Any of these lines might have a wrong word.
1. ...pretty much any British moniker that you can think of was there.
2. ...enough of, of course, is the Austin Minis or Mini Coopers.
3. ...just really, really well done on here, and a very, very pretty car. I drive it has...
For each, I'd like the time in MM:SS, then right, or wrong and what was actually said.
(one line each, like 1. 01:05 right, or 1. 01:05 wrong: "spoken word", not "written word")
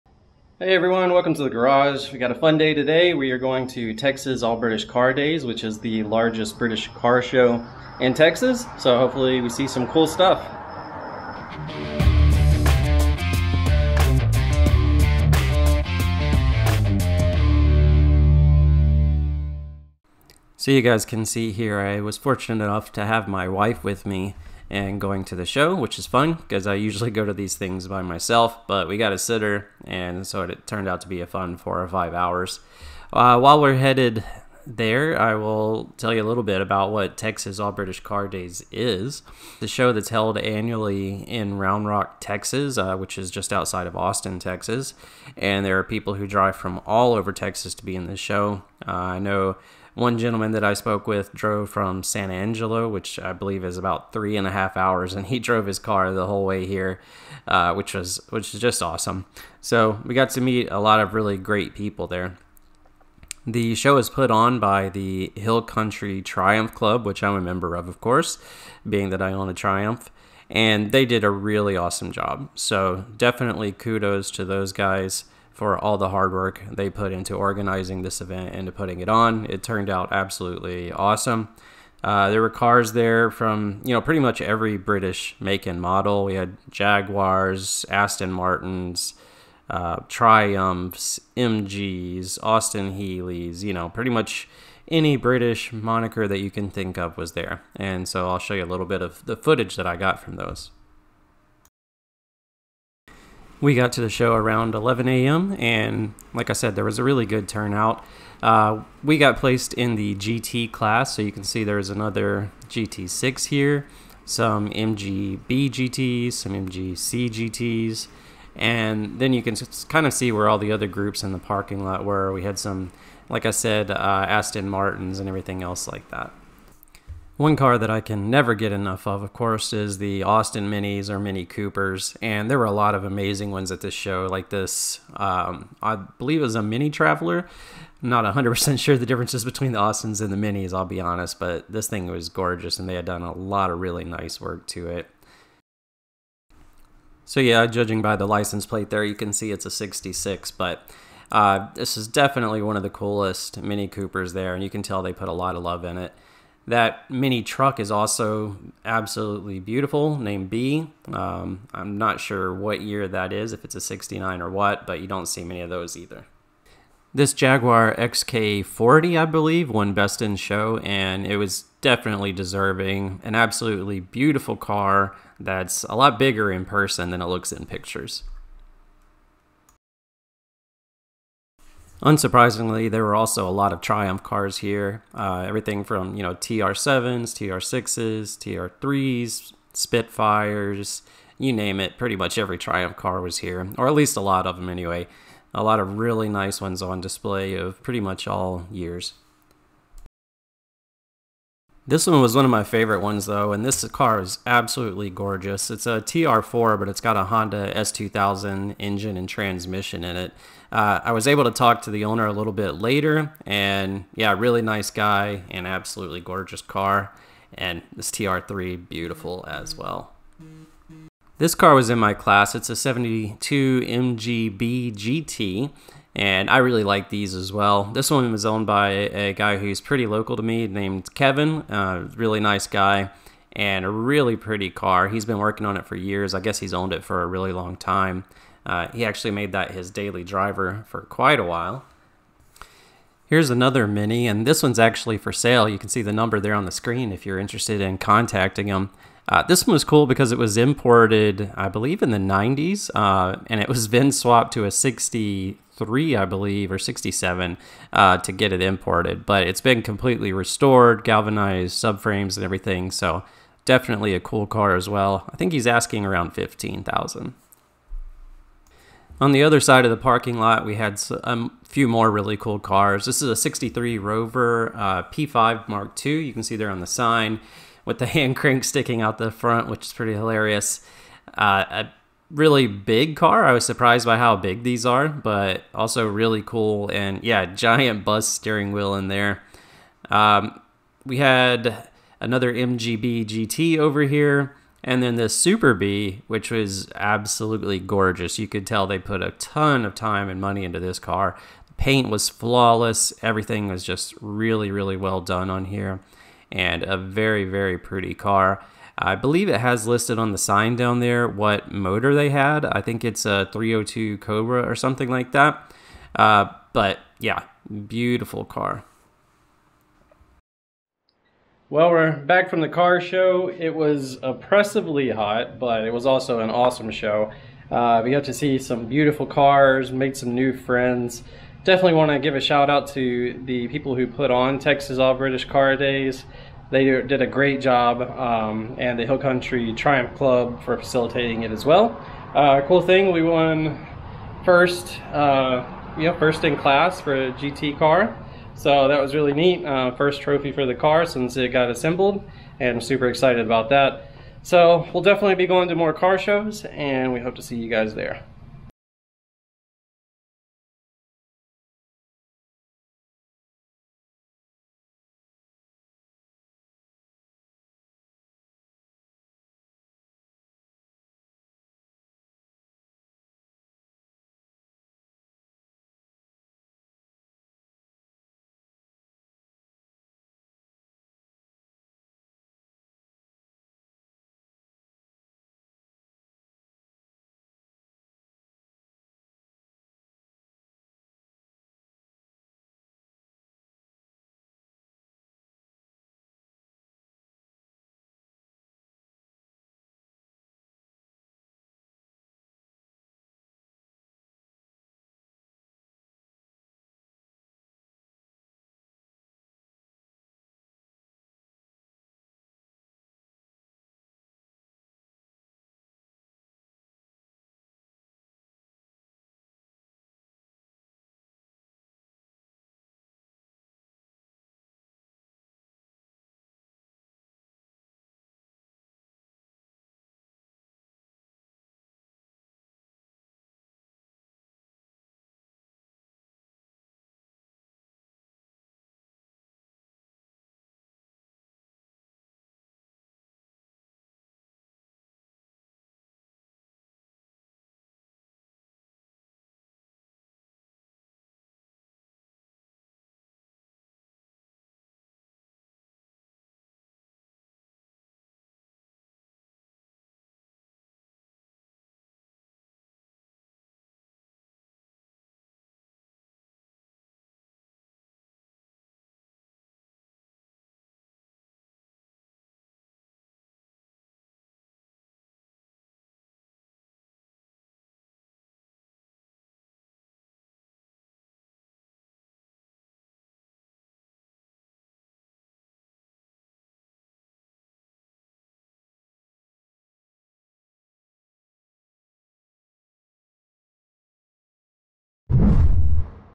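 1. 01:33 right
2. 02:08 right
3. 05:03 wrong: "believe", not "drive".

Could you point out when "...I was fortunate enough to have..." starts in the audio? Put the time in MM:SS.
00:21.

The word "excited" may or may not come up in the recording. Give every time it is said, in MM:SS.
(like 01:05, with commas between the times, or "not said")
05:53.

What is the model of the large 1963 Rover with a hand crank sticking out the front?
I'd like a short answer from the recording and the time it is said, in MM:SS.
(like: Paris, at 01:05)
P5 Mark II, at 04:35.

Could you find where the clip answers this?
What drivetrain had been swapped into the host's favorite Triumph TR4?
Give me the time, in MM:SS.
03:27.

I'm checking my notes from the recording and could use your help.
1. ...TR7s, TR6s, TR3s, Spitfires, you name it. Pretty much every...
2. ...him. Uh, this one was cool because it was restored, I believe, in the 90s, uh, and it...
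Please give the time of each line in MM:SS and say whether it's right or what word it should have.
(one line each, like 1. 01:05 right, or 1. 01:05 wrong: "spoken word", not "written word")
1. 03:06 right
2. 04:08 wrong: "imported", not "restored".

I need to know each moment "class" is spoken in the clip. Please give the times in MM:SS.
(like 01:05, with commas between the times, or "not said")
01:50, 03:42, 05:46.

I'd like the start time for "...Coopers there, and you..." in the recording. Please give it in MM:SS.
02:33.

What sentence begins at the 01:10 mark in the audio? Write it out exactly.
And they did a really awesome job.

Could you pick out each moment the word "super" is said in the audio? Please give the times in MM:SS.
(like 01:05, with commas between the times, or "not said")
04:55, 05:52.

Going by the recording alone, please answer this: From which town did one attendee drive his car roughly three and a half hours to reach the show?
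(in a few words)
San Angelo.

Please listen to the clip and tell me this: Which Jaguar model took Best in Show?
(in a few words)
XK40.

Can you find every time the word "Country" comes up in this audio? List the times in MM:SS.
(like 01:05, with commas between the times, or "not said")
01:05, 05:39.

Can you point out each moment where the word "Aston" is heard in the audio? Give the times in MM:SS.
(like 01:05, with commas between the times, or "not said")
01:27, 02:04.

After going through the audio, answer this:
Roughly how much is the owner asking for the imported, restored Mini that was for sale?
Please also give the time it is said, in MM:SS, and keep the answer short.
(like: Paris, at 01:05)
15,000, at 04:26.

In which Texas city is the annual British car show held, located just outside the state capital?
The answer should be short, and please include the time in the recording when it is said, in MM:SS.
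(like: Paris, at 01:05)
Round Rock, at 00:41.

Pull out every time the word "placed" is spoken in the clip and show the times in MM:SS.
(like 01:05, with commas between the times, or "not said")
01:49.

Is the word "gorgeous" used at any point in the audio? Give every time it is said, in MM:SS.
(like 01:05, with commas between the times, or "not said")
02:22, 03:25, 03:36, 04:57.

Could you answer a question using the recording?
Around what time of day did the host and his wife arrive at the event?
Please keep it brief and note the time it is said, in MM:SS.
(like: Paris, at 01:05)
11 a.m., at 01:44.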